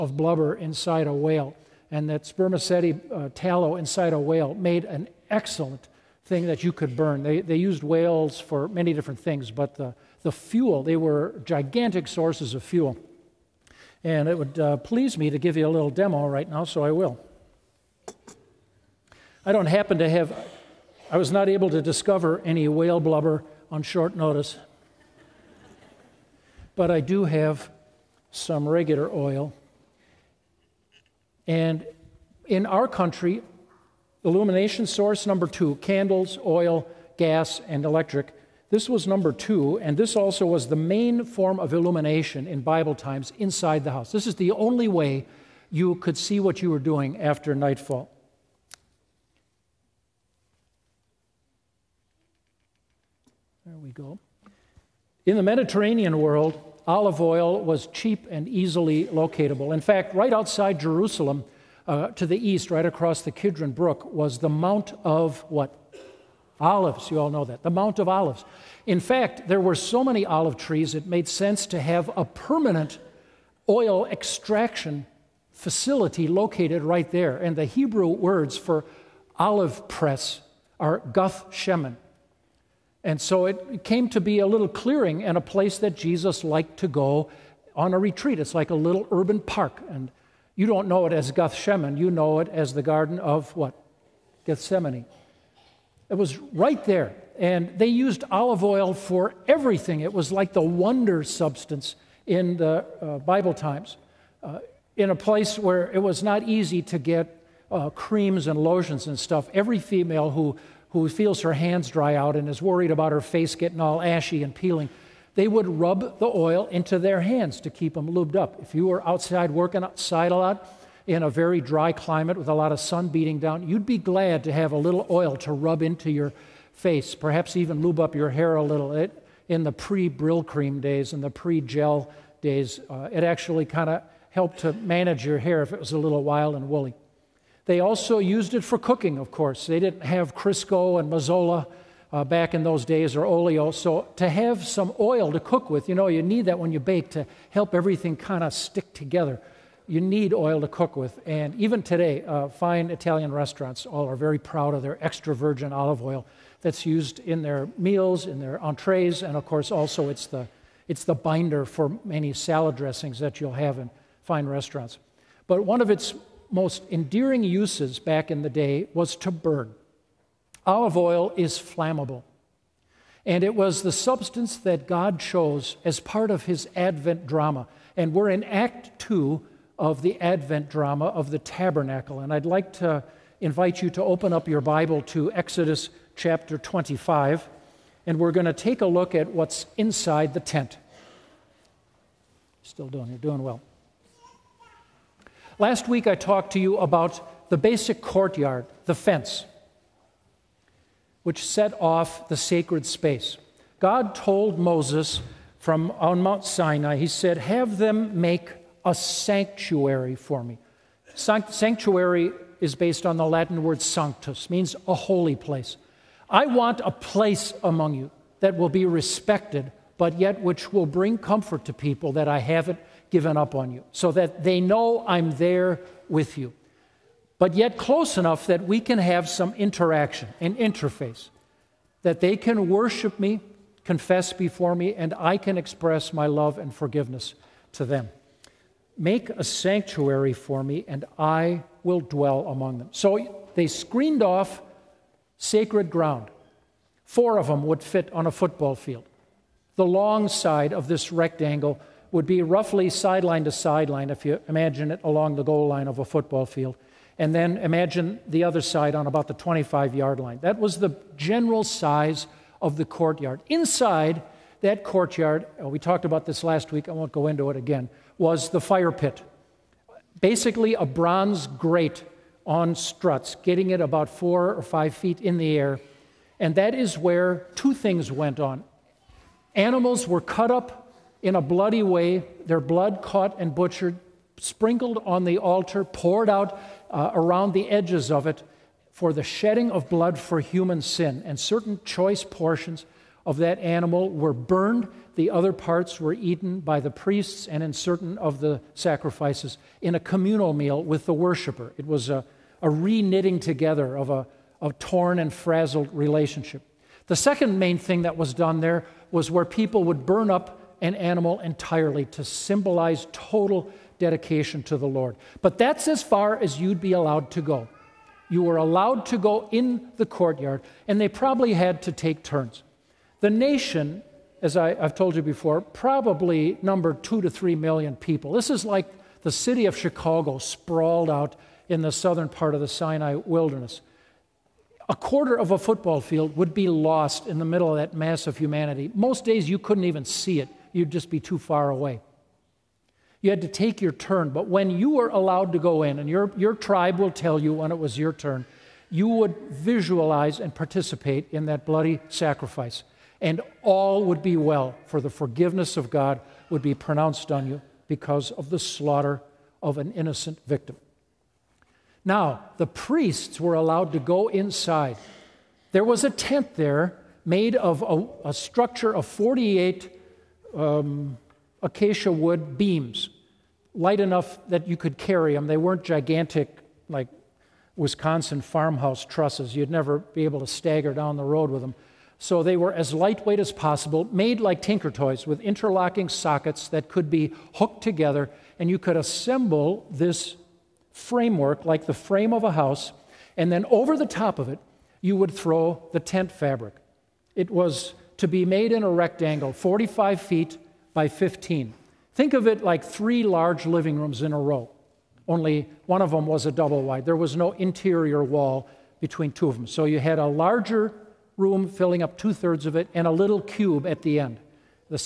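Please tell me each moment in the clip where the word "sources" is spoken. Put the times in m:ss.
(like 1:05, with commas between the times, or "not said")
0:12, 0:34.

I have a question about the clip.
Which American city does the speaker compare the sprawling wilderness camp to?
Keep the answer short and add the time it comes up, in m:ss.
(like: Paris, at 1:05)
Chicago, at 5:29.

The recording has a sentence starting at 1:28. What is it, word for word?
It's like a little urban park.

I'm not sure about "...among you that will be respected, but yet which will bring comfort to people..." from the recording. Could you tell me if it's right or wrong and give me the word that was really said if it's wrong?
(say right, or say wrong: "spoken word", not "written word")
right.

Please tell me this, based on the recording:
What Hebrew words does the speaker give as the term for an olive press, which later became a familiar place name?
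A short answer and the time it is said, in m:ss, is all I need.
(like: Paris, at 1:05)
Guth Shemen, at 1:20.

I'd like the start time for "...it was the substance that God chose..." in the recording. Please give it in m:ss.
2:53.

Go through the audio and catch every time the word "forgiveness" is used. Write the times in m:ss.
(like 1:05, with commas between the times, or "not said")
3:56, 5:55.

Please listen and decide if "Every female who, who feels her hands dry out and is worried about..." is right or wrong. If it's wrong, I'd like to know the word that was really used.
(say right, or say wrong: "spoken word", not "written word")
right.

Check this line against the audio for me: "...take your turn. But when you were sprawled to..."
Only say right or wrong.
wrong.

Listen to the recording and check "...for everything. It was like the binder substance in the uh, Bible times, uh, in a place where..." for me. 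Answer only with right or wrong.
wrong.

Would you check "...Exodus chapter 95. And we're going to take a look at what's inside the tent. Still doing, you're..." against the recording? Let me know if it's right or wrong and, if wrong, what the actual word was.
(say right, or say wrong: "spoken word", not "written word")
wrong: "25", not "95".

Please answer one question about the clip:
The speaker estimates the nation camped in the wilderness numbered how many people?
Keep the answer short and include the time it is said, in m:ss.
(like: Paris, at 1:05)
2 to 3 million, at 5:27.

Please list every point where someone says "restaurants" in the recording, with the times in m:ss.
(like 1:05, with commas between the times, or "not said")
2:33, 2:44.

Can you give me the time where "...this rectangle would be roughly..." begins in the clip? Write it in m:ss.
4:10.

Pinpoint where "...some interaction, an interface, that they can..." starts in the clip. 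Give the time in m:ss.
3:49.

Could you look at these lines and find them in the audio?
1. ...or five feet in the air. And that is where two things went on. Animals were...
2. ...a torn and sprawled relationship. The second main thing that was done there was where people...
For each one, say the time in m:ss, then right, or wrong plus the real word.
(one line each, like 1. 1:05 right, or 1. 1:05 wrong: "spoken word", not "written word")
1. 4:34 right
2. 5:04 wrong: "frazzled", not "sprawled".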